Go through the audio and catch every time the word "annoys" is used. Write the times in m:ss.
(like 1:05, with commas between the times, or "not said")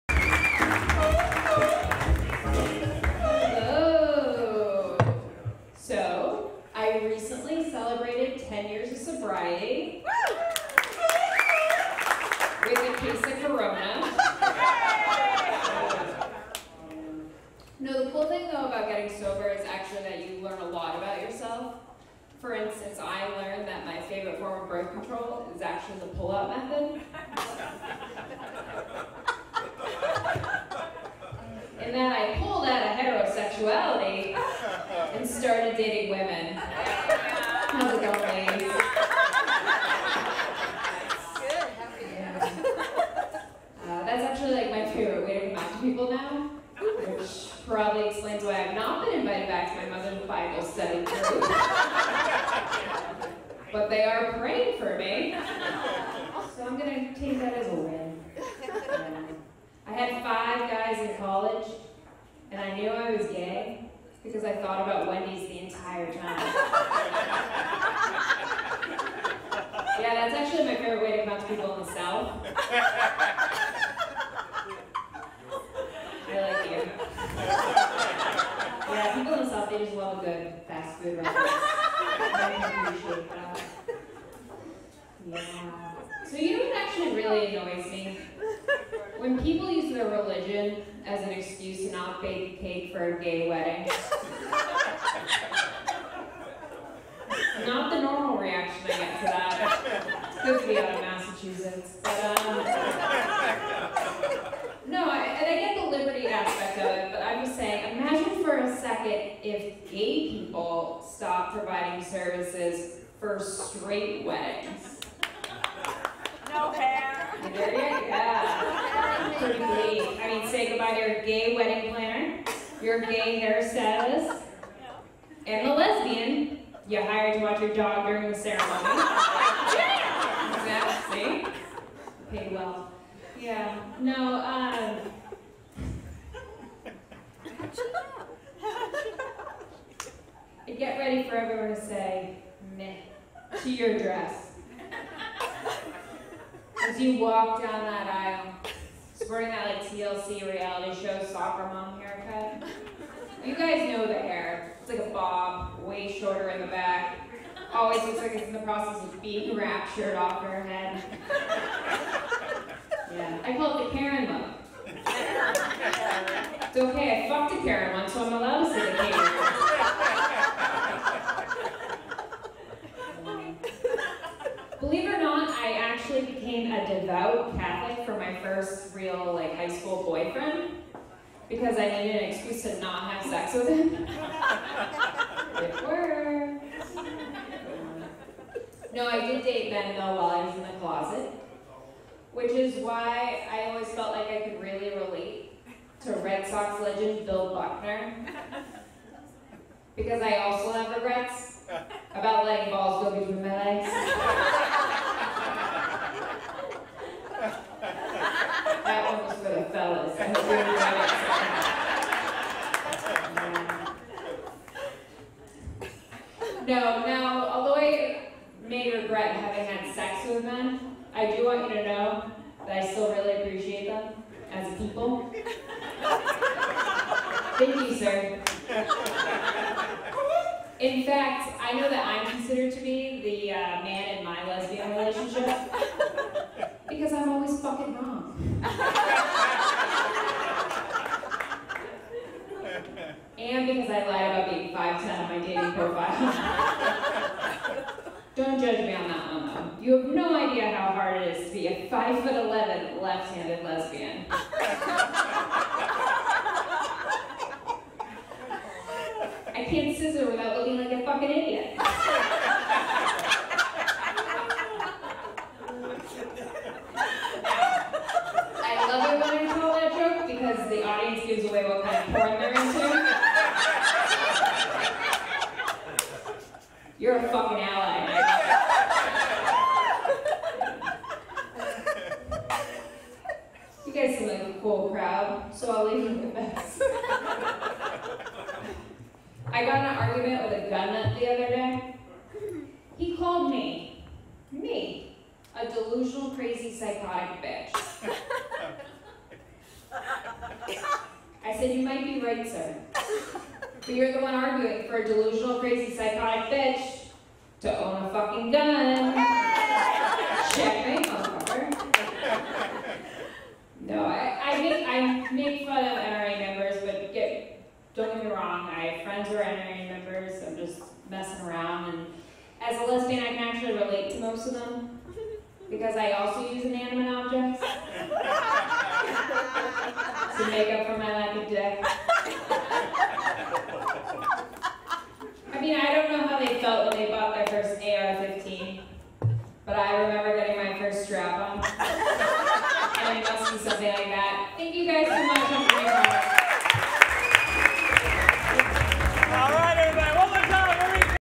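1:27.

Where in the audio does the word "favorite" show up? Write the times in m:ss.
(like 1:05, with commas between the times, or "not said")
0:24, 1:10.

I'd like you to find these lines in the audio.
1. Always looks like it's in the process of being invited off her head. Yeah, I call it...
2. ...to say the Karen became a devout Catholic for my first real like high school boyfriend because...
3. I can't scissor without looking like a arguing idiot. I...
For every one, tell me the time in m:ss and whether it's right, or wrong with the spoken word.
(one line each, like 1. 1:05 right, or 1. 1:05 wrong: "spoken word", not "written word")
1. 2:37 wrong: "raptured", not "invited"
2. 2:48 right
3. 4:14 wrong: "fucking", not "arguing".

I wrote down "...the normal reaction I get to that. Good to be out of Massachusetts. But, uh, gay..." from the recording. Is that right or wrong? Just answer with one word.
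right.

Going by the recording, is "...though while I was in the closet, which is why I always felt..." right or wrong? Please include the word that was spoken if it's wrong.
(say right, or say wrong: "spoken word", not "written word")
right.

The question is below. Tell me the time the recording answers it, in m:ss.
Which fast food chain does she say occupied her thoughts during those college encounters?
1:05.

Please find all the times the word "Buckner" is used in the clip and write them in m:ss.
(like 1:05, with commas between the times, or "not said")
3:17.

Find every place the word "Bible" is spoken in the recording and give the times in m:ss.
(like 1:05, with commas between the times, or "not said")
0:50.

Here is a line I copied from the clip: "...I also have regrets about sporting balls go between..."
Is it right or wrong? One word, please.
wrong.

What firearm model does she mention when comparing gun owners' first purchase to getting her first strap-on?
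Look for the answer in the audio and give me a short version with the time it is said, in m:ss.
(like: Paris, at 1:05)
AR-15, at 5:37.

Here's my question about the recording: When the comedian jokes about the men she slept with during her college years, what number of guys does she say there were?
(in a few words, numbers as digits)
5.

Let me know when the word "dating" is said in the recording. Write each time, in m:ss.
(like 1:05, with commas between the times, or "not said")
0:35, 4:05.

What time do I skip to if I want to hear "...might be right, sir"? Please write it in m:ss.
5:01.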